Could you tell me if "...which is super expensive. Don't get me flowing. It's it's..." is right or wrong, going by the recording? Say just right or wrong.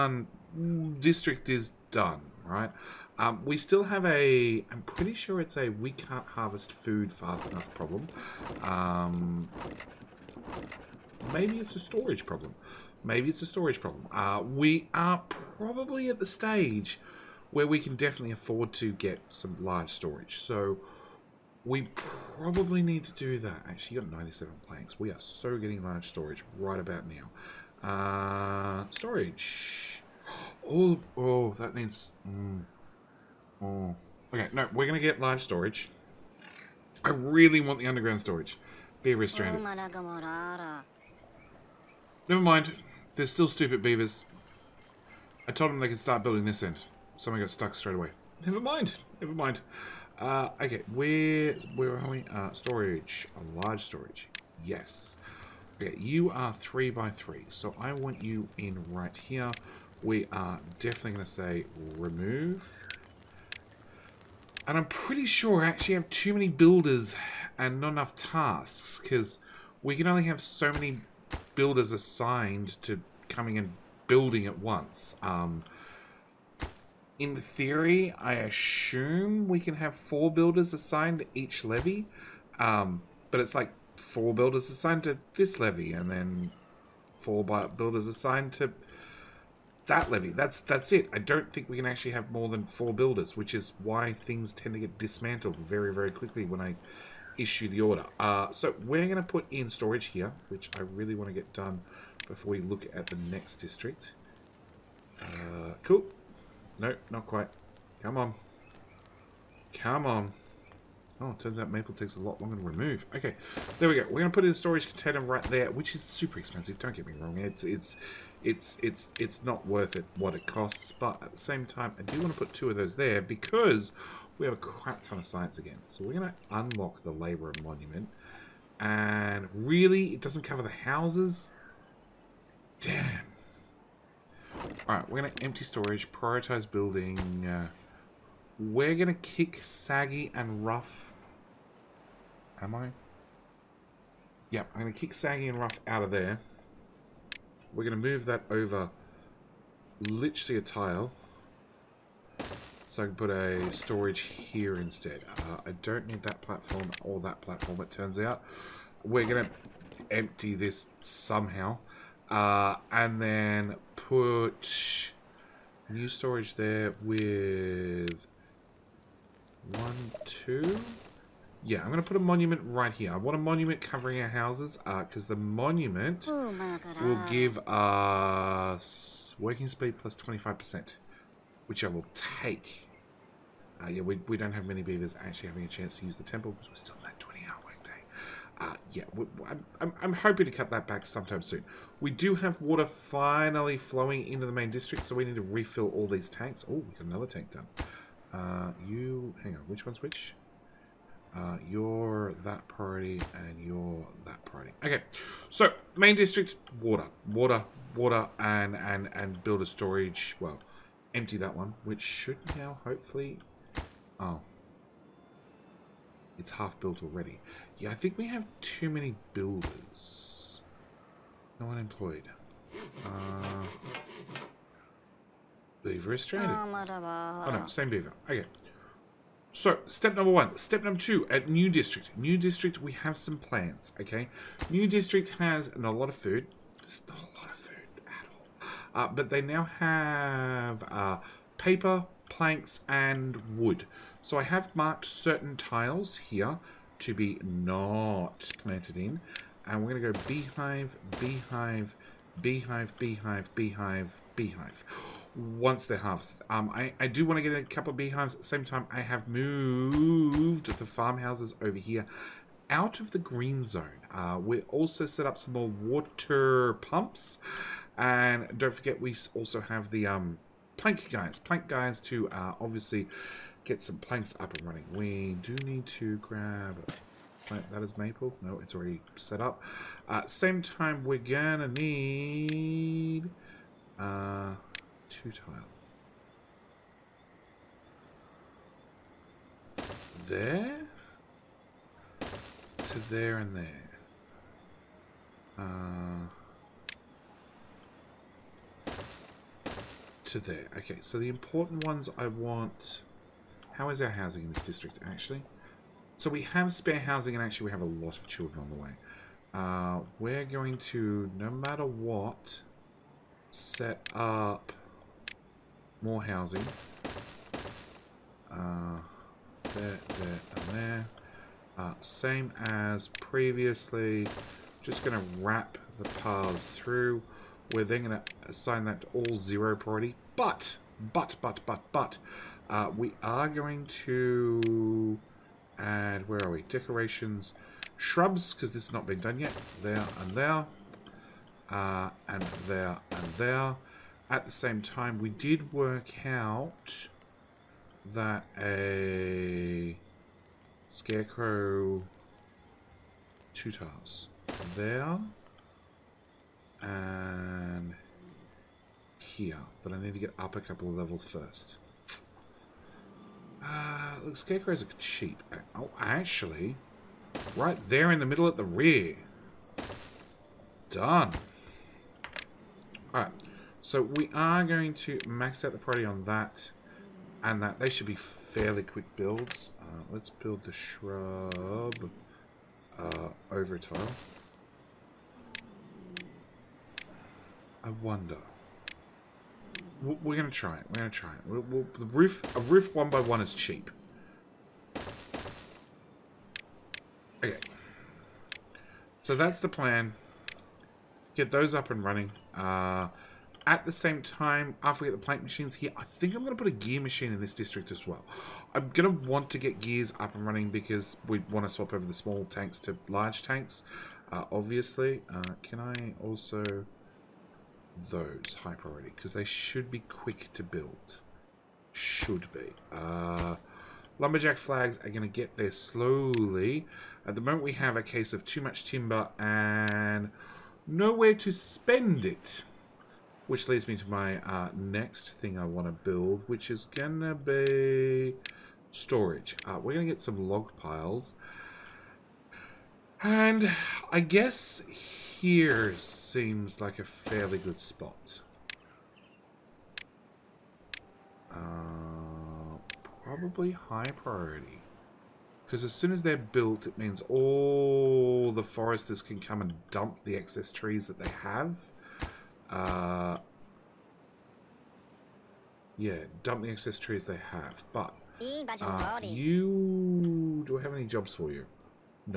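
wrong.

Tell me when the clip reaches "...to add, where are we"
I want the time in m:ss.
5:34.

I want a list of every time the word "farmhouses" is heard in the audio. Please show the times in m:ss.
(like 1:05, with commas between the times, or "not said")
4:20.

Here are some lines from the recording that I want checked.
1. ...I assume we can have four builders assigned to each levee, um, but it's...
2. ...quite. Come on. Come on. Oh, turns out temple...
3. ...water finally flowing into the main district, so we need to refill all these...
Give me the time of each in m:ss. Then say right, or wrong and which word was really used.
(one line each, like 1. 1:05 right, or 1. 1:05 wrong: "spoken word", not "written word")
1. 1:18 right
2. 1:47 wrong: "maple", not "temple"
3. 3:12 right.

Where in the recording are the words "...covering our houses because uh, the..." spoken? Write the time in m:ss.
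2:53.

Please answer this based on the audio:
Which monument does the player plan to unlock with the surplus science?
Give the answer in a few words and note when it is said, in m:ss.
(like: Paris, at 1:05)
Labour Monument, at 2:07.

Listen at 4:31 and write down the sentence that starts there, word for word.
Plank guys to uh, obviously get some planks up and running.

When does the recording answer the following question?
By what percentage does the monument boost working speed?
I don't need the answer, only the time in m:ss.
2:59.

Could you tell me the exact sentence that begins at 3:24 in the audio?
Okay, so main district, water, water, water, and and and build a storage.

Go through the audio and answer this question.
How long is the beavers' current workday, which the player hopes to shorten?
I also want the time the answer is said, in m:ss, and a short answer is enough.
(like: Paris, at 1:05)
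20 hours, at 3:07.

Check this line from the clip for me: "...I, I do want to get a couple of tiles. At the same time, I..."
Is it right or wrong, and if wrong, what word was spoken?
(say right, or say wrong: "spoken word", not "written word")
wrong: "beehives", not "tiles".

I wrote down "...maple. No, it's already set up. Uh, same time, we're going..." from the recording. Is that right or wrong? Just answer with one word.
right.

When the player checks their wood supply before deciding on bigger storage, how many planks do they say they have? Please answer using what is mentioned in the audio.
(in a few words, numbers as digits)
97.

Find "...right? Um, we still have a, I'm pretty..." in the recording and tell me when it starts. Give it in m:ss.
0:02.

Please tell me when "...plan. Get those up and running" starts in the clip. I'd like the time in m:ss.
6:39.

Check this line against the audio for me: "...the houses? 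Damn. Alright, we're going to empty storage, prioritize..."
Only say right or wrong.
right.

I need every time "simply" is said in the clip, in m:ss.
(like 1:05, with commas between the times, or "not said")
not said.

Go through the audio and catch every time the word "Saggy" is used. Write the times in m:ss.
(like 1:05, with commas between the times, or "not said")
2:19, 2:25.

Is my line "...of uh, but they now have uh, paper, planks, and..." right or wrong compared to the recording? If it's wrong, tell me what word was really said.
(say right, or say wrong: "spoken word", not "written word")
right.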